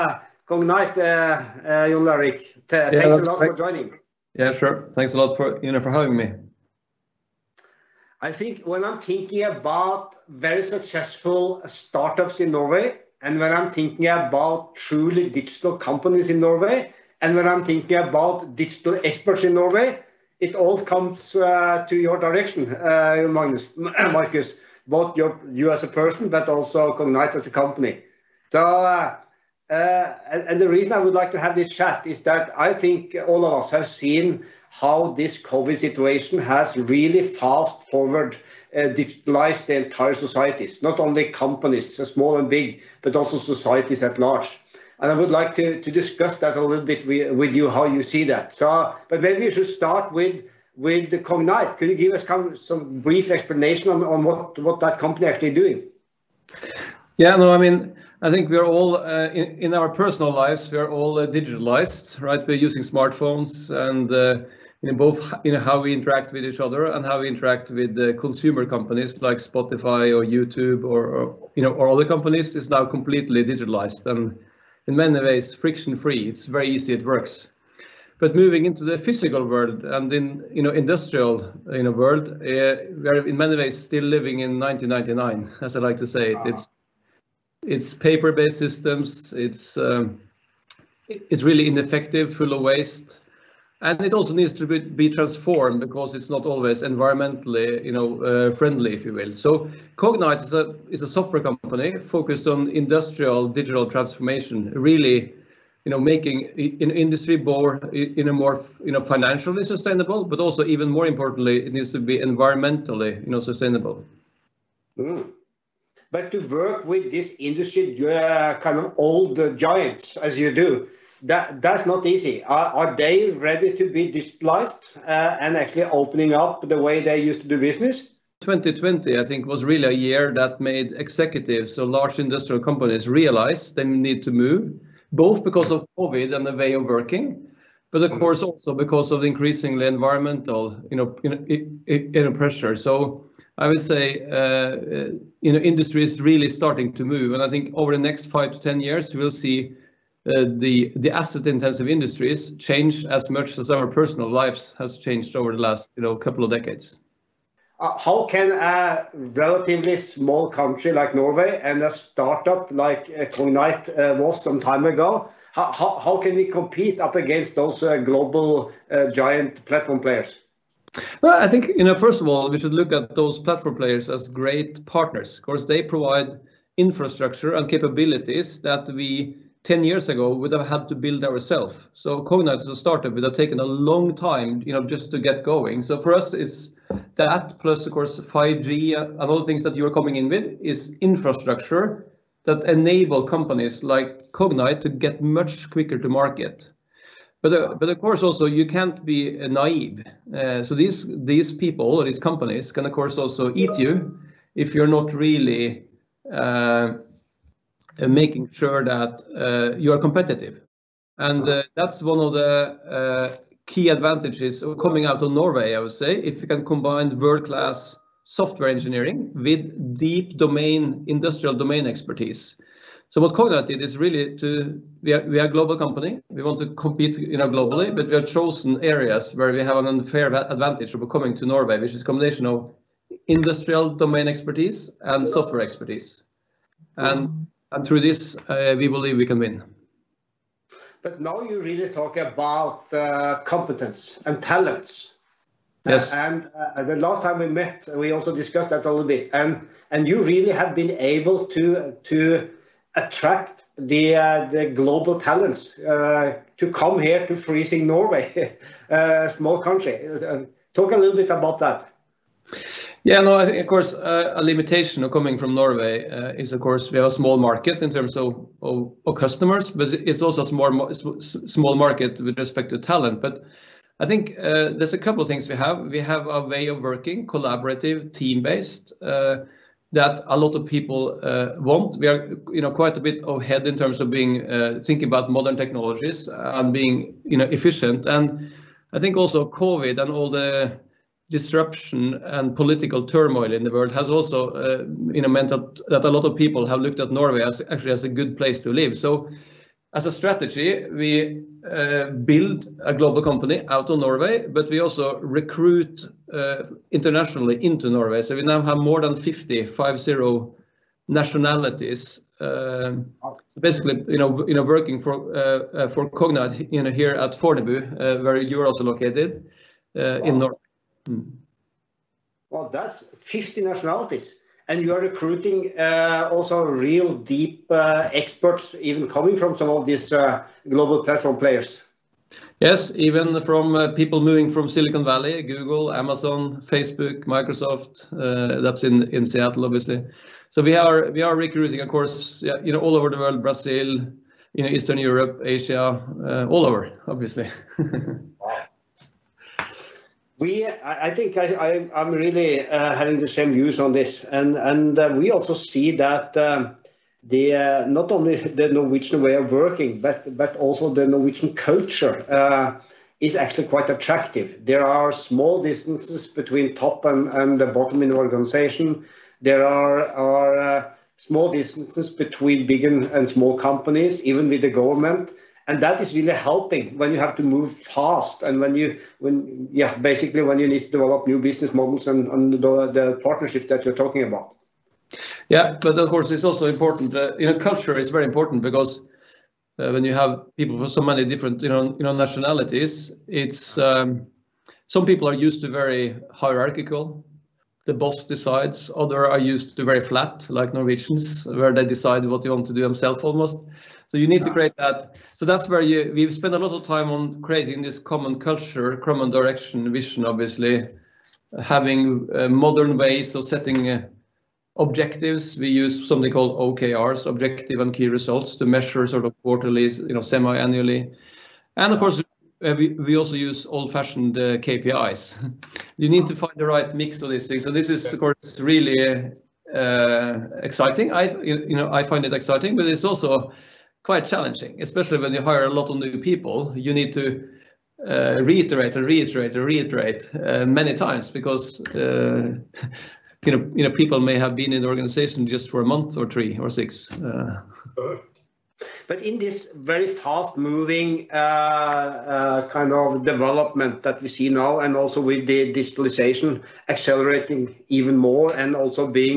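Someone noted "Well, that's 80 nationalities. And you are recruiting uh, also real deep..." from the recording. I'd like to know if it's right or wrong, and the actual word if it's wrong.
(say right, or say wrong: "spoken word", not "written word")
wrong: "50", not "80".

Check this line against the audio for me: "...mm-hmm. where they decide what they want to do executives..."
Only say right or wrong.
wrong.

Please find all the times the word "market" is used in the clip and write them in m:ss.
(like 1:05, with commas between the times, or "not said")
3:16, 4:27, 4:31.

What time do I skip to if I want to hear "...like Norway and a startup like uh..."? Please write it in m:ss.
2:40.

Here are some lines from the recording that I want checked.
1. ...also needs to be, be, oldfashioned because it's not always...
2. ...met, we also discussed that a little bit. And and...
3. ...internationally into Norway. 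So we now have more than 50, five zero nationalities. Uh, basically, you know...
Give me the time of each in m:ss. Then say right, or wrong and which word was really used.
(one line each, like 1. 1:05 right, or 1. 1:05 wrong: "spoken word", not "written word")
1. 1:34 wrong: "transformed", not "oldfashioned"
2. 4:07 right
3. 5:06 right.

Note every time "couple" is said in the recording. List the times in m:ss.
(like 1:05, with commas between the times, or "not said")
2:36, 4:34.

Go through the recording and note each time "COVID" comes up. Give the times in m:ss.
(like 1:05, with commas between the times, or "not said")
0:35, 2:15, 4:49.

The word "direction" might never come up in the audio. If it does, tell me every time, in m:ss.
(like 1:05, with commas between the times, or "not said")
0:22, 6:49.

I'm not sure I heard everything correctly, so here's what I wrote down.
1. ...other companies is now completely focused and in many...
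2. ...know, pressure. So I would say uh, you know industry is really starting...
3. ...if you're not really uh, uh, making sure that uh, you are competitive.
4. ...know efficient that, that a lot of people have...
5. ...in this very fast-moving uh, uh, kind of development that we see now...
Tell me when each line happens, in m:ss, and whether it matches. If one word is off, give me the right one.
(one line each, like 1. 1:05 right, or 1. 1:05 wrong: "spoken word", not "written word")
1. 1:11 wrong: "digitalized", not "focused"
2. 2:22 right
3. 3:24 right
4. 4:55 wrong: "meant", not "efficient"
5. 7:29 right.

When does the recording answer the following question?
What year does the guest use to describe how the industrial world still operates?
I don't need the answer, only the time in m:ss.
1:24.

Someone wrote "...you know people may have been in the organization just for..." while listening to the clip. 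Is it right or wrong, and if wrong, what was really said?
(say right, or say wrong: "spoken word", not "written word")
right.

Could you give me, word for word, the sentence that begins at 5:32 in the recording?
Yes, even from uh, people moving from Silicon Valley, Google, Amazon, Facebook, Microsoft.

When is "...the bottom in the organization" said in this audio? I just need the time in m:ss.
6:07.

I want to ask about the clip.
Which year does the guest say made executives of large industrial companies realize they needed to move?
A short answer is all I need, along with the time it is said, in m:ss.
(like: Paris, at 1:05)
2020, at 2:08.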